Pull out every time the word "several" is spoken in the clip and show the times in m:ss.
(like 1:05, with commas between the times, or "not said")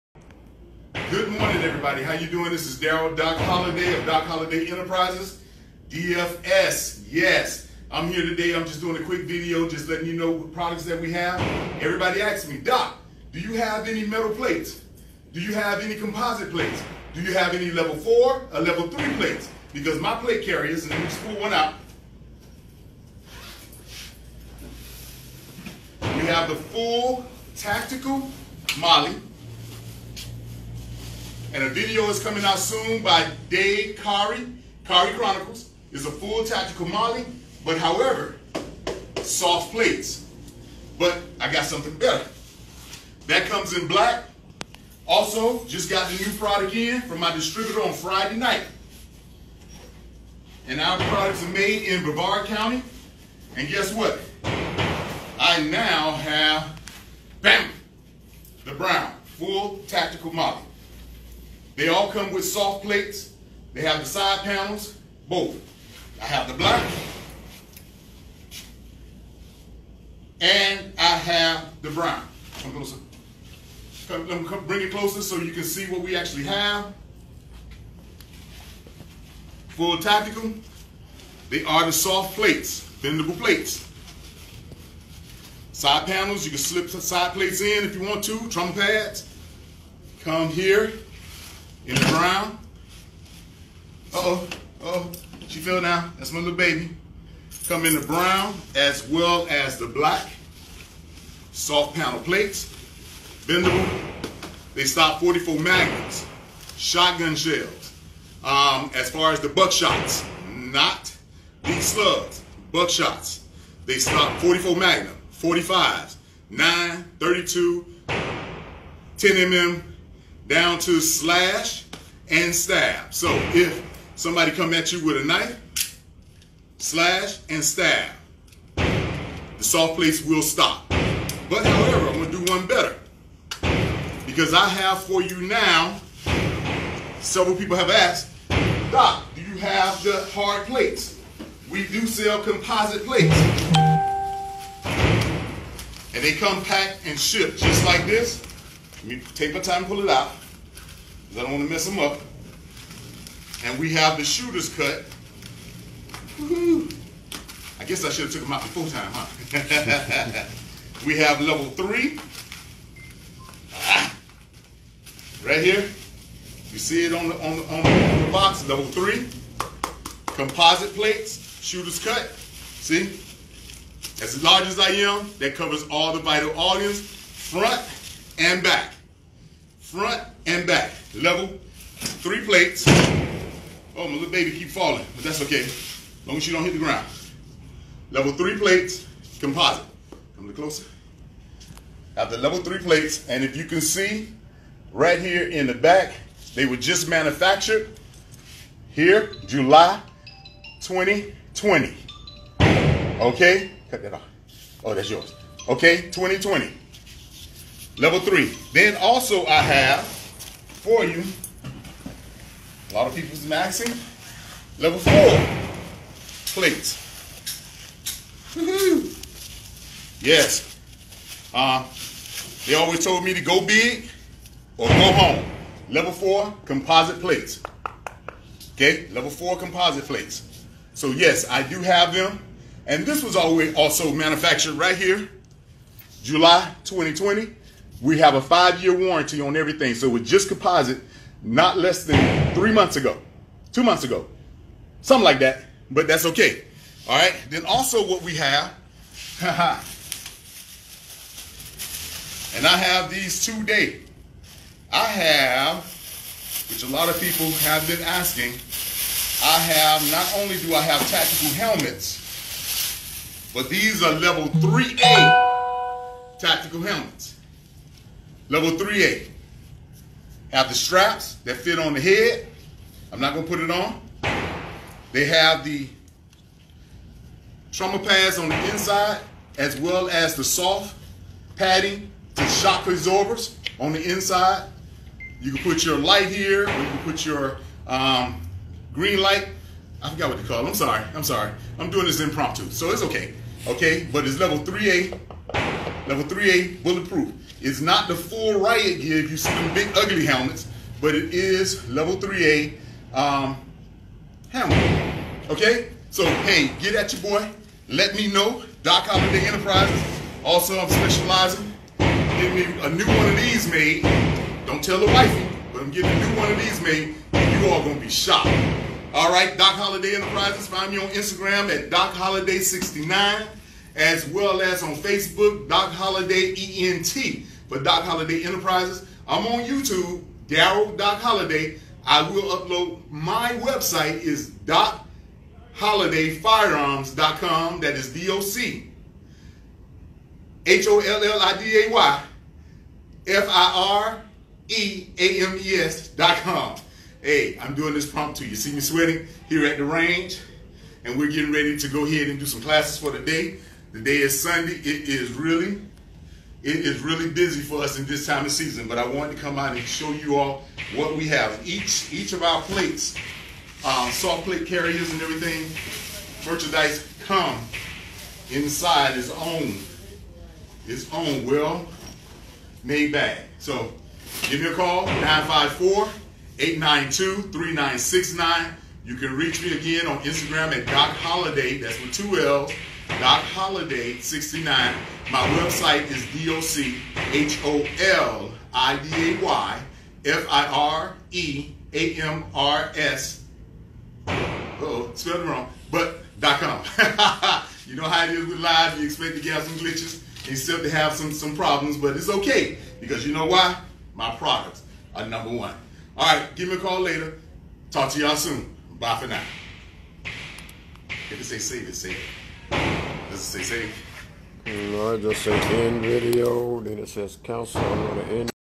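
2:17.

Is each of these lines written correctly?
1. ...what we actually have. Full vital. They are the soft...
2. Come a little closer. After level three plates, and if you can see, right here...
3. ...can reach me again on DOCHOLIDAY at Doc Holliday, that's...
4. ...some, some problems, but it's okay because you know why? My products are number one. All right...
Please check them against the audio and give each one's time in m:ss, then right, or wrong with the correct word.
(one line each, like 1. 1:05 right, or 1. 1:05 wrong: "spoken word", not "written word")
1. 1:15 wrong: "tactical", not "vital"
2. 3:10 right
3. 6:19 wrong: "Instagram", not "DOCHOLIDAY"
4. 6:41 right.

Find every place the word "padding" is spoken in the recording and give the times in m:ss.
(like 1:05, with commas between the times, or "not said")
4:41.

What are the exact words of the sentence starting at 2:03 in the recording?
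So if somebody come at you with a knife, slash and stab.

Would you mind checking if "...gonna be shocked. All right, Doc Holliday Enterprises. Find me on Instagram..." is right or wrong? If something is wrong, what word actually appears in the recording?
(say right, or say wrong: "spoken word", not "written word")
right.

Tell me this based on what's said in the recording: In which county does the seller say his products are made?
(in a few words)
Brevard County.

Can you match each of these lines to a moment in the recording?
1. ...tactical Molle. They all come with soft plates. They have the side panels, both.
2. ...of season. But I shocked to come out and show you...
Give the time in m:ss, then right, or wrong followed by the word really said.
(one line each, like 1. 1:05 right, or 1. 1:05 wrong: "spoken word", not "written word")
1. 0:59 right
2. 5:58 wrong: "wanted", not "shocked".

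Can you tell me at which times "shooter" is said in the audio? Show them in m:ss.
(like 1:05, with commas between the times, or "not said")
2:34, 2:51.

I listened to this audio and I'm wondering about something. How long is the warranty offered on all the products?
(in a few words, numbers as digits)
5 years.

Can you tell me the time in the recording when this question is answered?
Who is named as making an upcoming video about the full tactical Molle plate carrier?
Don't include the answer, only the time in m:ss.
0:33.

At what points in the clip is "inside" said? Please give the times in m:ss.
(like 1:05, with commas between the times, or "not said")
4:38, 4:44, 6:08.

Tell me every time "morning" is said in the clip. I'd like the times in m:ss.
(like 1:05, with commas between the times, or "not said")
0:01.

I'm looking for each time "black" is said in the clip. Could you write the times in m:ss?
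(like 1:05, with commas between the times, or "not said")
0:43, 1:06, 1:39.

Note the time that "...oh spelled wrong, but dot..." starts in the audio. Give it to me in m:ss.
6:34.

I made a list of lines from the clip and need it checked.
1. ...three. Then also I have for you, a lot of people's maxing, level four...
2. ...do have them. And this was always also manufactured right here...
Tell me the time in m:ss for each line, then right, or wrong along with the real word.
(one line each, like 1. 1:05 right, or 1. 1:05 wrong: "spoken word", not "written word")
1. 3:28 right
2. 3:51 right.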